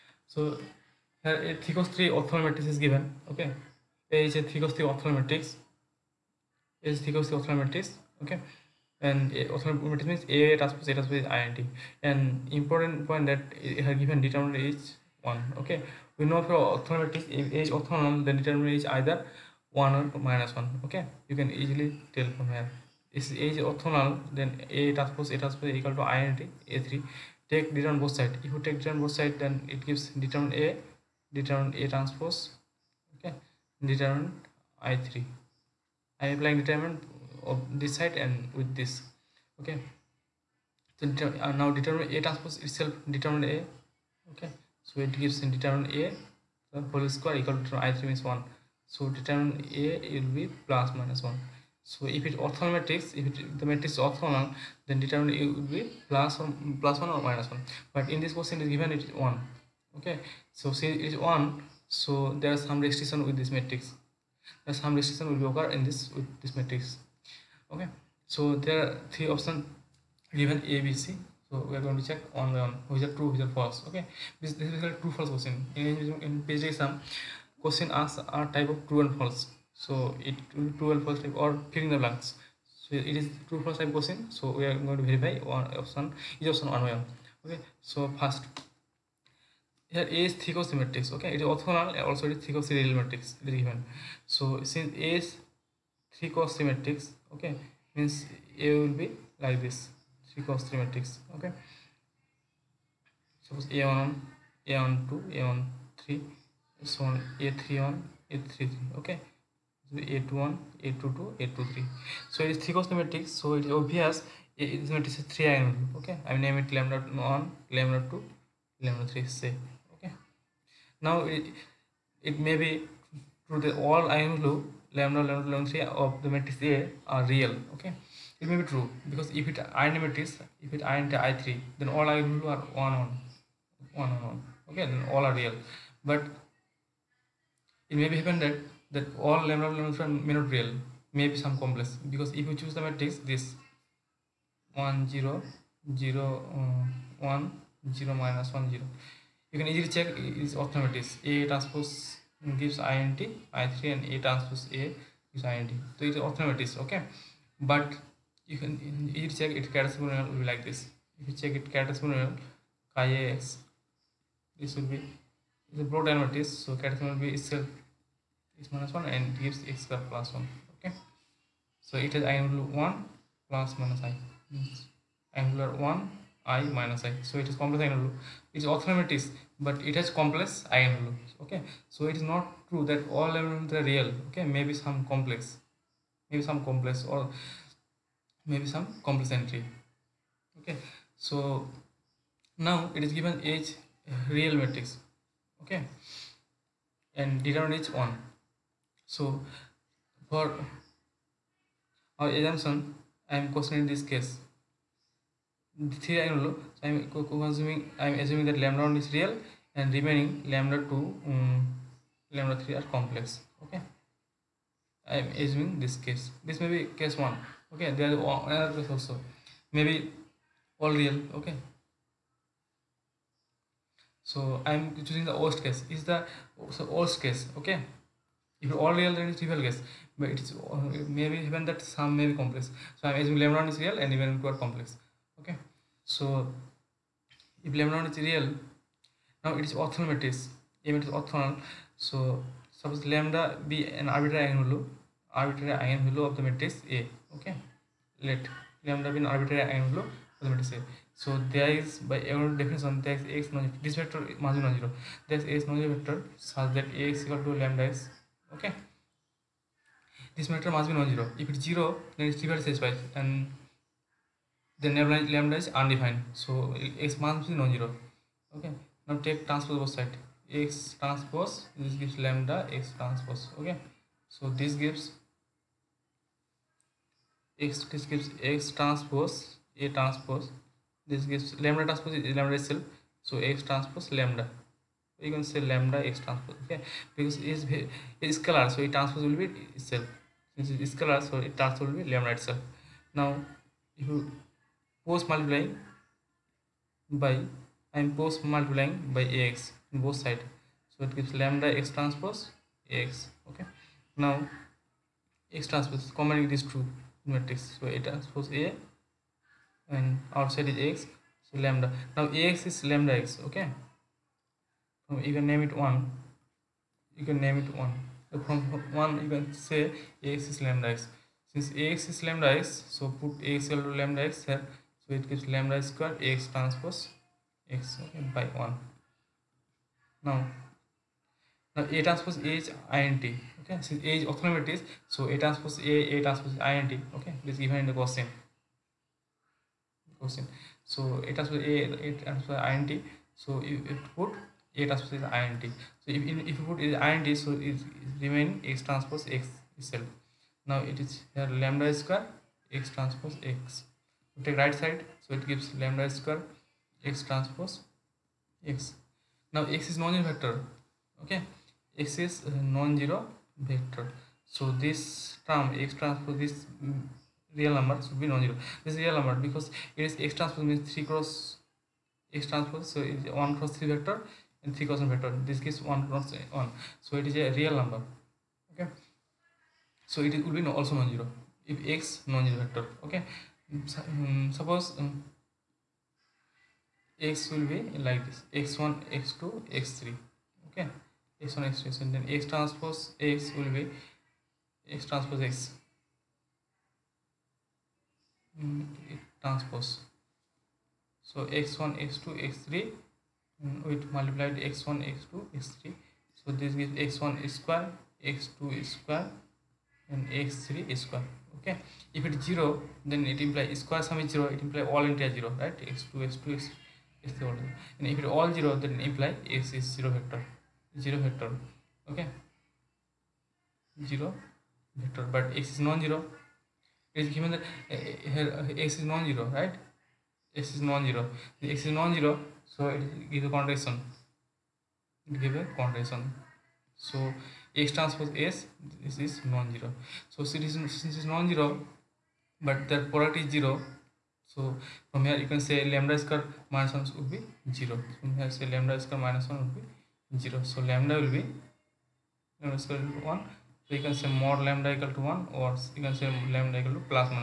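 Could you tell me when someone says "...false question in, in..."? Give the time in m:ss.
1:15.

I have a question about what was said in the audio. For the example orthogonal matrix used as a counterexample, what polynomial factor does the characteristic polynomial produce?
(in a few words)
x^2 + 1.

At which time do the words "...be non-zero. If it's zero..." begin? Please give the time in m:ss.
4:20.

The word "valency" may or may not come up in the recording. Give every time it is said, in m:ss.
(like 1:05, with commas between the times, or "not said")
2:05, 2:19.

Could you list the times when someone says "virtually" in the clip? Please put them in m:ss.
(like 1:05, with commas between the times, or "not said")
not said.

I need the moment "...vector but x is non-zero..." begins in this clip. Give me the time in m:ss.
7:05.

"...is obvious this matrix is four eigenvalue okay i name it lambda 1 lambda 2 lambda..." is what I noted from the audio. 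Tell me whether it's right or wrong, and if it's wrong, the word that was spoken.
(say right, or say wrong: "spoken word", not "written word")
wrong: "three", not "four".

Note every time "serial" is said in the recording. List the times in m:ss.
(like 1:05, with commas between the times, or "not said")
1:32.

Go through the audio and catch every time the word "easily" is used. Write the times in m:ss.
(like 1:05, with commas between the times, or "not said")
0:21, 2:29.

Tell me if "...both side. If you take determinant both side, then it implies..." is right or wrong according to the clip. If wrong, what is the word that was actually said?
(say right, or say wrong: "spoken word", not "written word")
wrong: "gives", not "implies".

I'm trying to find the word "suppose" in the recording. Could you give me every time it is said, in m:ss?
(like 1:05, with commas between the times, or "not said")
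1:43, 4:02, 6:24.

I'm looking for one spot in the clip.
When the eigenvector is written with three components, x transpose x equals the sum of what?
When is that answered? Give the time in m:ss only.
6:47.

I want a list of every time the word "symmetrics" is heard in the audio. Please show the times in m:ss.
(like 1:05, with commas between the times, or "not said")
1:30.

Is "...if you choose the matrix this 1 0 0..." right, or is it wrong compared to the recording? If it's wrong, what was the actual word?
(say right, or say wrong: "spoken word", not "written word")
right.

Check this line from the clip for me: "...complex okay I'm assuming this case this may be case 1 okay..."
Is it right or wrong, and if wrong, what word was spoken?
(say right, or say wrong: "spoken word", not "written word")
right.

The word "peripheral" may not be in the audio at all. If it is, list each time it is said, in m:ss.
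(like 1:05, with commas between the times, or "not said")
not said.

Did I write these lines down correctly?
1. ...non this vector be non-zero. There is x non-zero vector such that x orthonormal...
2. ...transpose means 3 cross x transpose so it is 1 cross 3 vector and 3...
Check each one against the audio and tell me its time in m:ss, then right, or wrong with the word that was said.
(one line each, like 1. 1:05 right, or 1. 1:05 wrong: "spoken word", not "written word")
1. 4:13 wrong: "equal", not "orthonormal"
2. 6:10 right.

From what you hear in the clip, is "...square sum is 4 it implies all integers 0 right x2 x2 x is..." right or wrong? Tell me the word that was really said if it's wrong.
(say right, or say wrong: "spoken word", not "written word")
wrong: "0", not "4".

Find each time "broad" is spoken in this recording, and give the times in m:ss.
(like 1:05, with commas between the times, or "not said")
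2:45.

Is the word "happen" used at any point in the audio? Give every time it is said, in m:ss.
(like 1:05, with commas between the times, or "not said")
2:18.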